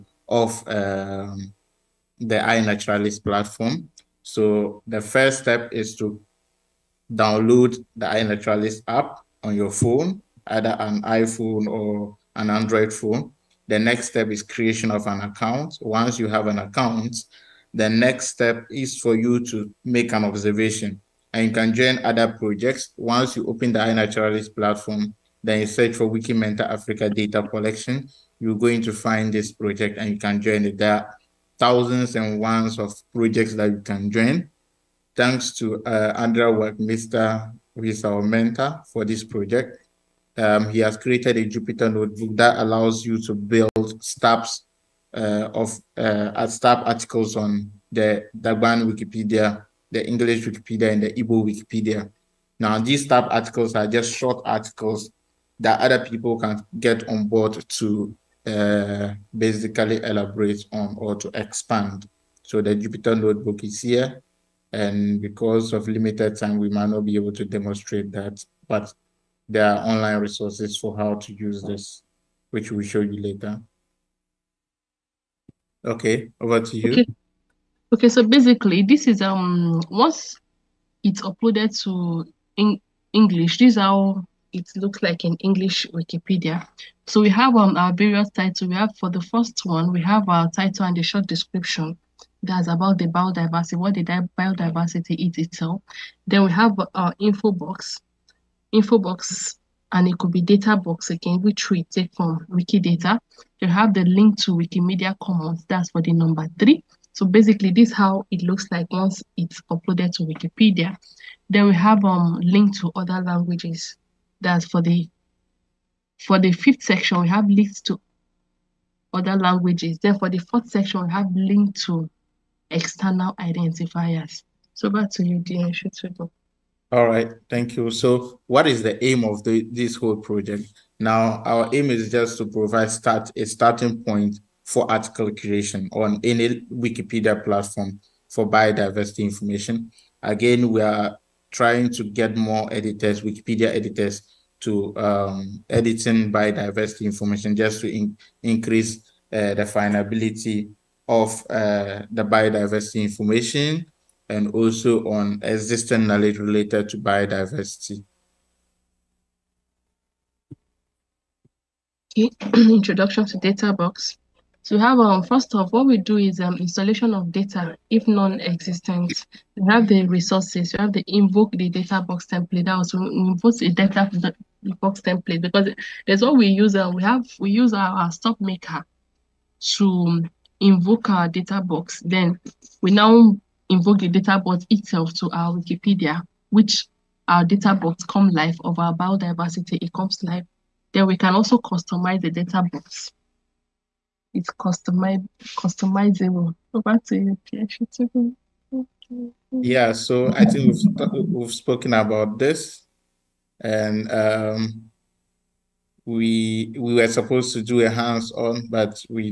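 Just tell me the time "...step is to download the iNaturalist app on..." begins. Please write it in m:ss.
0:05.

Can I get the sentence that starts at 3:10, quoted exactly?
Then we can also customize the data box it's customiz- customizable.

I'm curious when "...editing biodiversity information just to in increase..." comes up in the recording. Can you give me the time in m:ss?
2:25.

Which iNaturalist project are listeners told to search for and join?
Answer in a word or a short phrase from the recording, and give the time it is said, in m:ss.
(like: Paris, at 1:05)
Wiki Mentor Africa data collection, at 0:26.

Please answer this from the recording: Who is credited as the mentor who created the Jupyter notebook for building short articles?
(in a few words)
Andrea.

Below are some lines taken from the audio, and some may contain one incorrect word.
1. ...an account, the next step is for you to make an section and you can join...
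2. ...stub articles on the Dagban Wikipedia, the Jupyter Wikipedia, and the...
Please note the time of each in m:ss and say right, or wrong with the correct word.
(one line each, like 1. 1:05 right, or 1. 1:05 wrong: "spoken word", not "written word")
1. 0:16 wrong: "observation", not "section"
2. 0:46 wrong: "English", not "Jupyter".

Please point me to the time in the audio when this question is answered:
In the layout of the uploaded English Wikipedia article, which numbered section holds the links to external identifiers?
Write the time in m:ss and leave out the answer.
2:00.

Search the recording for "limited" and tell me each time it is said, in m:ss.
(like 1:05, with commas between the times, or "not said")
1:05.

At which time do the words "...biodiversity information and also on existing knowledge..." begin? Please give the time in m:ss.
2:32.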